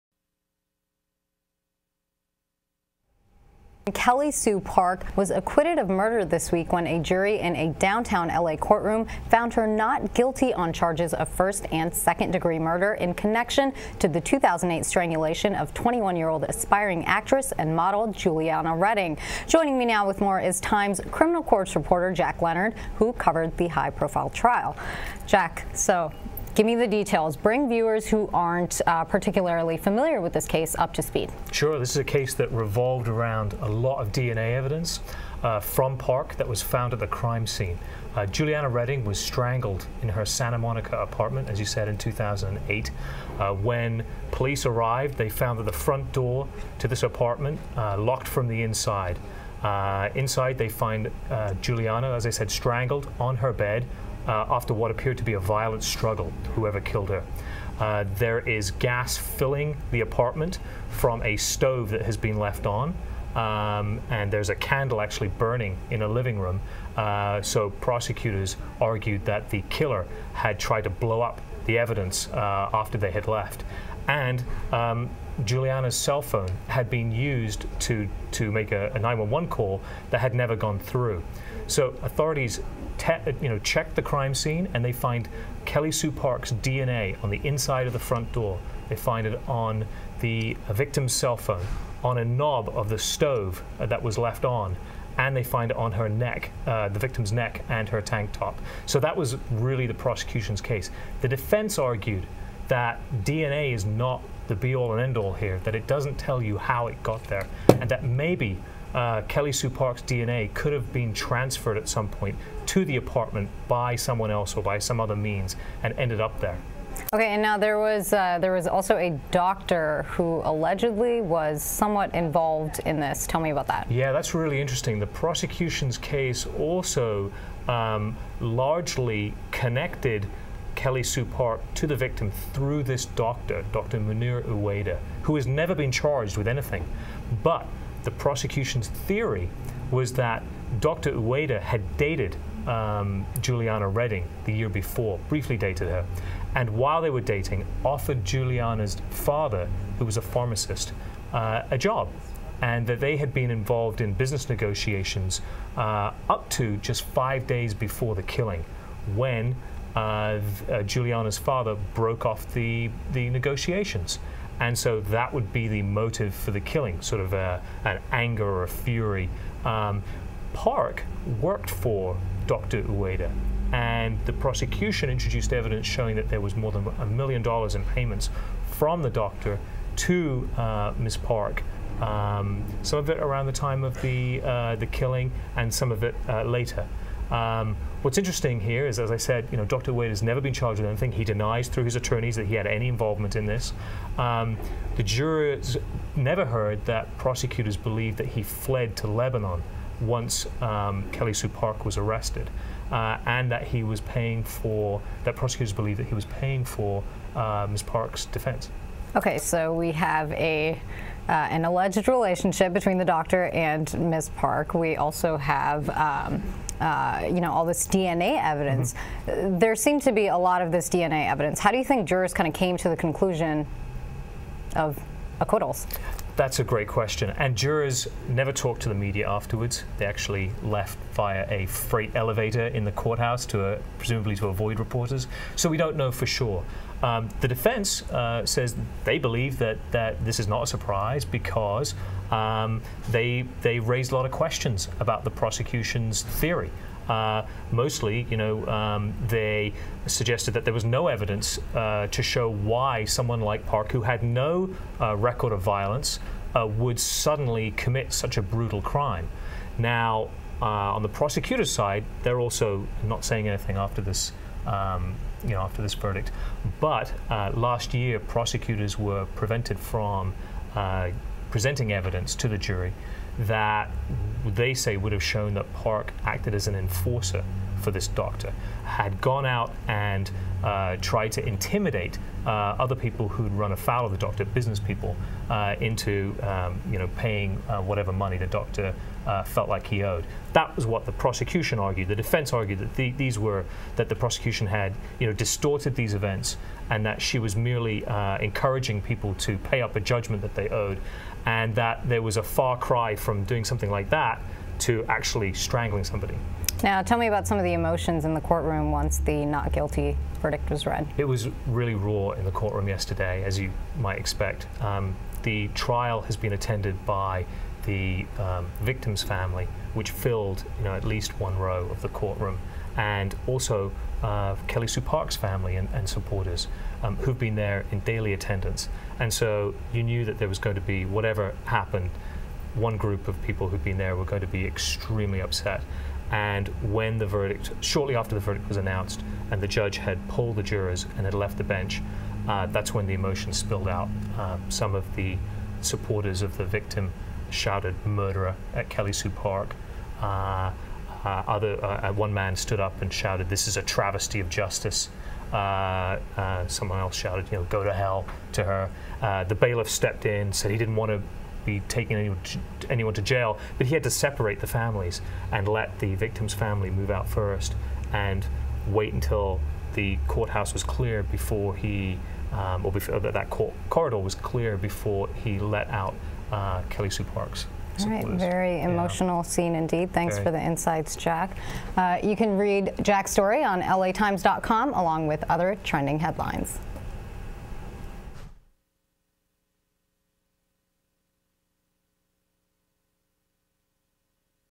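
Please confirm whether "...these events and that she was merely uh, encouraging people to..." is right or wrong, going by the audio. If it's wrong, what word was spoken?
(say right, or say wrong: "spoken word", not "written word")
right.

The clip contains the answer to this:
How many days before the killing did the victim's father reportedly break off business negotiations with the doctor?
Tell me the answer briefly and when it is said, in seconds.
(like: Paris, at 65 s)
5, at 157 s.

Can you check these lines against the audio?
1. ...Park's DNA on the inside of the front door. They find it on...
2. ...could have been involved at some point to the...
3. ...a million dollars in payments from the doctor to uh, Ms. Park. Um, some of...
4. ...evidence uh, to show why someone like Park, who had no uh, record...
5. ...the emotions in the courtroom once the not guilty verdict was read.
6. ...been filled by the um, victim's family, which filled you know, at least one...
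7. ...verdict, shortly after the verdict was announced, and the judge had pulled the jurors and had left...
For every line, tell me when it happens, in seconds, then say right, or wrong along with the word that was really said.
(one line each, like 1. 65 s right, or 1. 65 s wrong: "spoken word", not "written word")
1. 86 s right
2. 110 s wrong: "transferred", not "involved"
3. 176 s right
4. 251 s right
5. 307 s right
6. 316 s wrong: "attended", not "filled"
7. 337 s right.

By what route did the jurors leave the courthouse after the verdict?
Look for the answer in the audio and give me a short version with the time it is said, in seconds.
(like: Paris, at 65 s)
Freight elevator, at 231 s.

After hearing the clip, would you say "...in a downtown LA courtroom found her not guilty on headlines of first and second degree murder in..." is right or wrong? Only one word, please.
wrong.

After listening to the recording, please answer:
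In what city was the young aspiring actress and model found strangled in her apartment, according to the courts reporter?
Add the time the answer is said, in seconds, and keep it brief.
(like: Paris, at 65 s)
Santa Monica, at 40 s.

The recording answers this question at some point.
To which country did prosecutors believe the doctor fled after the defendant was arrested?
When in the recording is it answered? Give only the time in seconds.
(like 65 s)
199 s.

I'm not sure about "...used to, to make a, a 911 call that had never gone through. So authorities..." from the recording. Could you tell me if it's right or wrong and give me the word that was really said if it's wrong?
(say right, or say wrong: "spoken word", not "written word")
right.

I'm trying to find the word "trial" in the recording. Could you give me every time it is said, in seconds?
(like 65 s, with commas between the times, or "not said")
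24 s, 315 s.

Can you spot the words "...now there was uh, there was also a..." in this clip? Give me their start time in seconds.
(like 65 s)
117 s.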